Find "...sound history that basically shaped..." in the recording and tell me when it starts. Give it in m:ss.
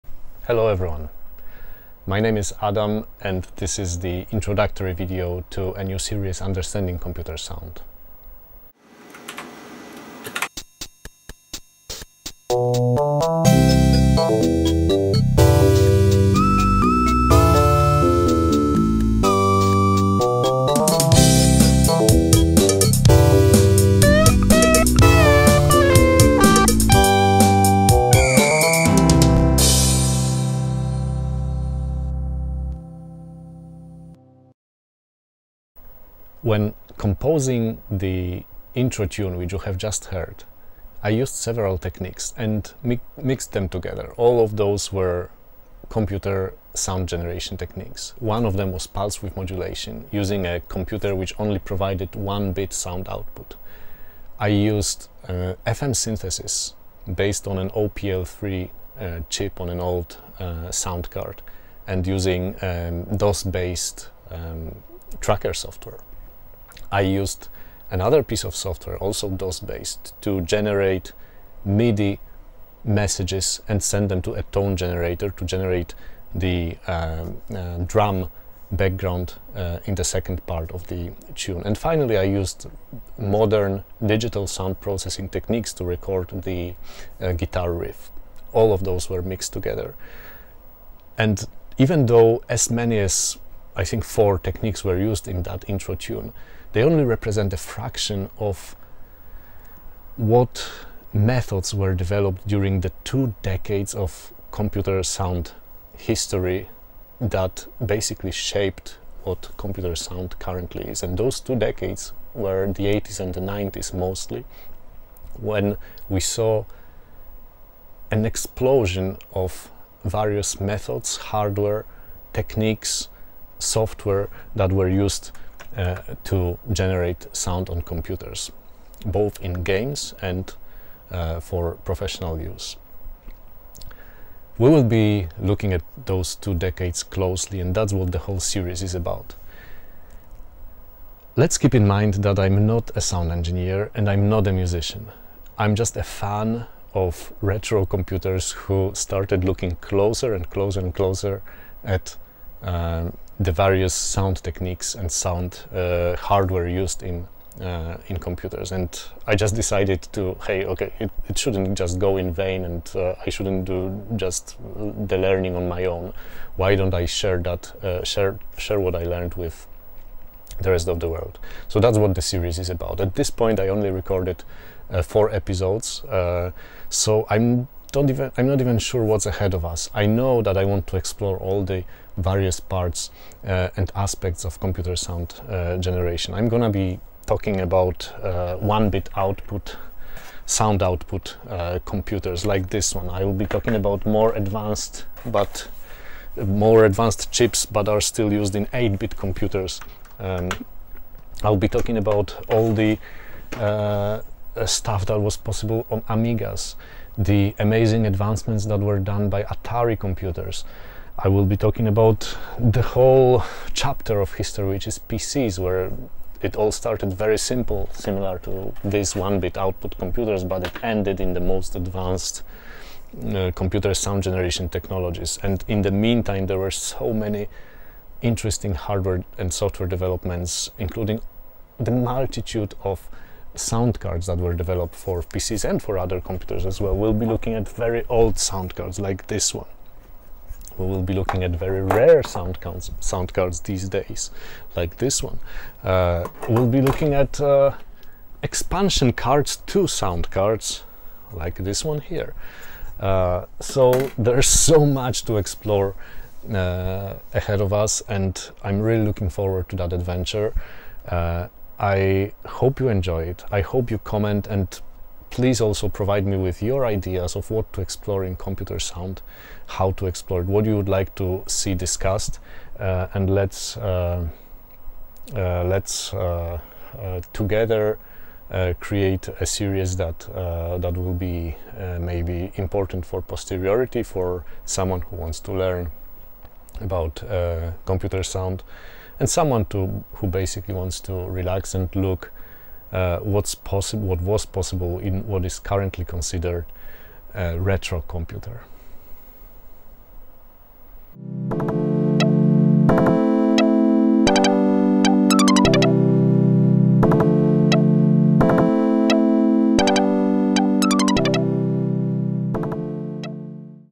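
1:45.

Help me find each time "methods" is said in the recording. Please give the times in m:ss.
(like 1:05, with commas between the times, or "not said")
1:41, 2:00.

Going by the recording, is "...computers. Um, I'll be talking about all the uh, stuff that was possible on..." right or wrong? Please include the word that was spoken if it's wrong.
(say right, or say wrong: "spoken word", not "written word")
right.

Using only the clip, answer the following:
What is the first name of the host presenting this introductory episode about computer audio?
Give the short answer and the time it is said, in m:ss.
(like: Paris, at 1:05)
Adam, at 0:02.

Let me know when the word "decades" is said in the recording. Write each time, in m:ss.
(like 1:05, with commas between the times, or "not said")
1:43, 1:51, 2:16.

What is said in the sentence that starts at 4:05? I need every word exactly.
Uh, we'll be looking at uh, expansion cards to sound cards, like this one here.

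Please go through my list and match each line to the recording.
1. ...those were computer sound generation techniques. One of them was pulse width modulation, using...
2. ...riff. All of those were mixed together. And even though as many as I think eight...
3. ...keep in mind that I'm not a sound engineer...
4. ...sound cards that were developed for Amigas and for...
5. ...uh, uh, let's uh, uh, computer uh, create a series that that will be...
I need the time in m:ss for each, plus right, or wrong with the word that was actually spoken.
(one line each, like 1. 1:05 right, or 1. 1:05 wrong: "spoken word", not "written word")
1. 0:44 right
2. 1:27 wrong: "four", not "eight"
3. 2:21 right
4. 3:53 wrong: "PCs", not "Amigas"
5. 4:33 wrong: "together", not "computer".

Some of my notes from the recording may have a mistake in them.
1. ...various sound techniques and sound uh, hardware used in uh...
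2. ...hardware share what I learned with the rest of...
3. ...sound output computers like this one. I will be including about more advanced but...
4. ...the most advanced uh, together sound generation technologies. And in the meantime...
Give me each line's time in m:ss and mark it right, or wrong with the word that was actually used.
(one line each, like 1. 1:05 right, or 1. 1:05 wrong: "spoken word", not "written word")
1. 2:33 right
2. 2:48 wrong: "share", not "hardware"
3. 3:10 wrong: "talking", not "including"
4. 3:41 wrong: "computer", not "together".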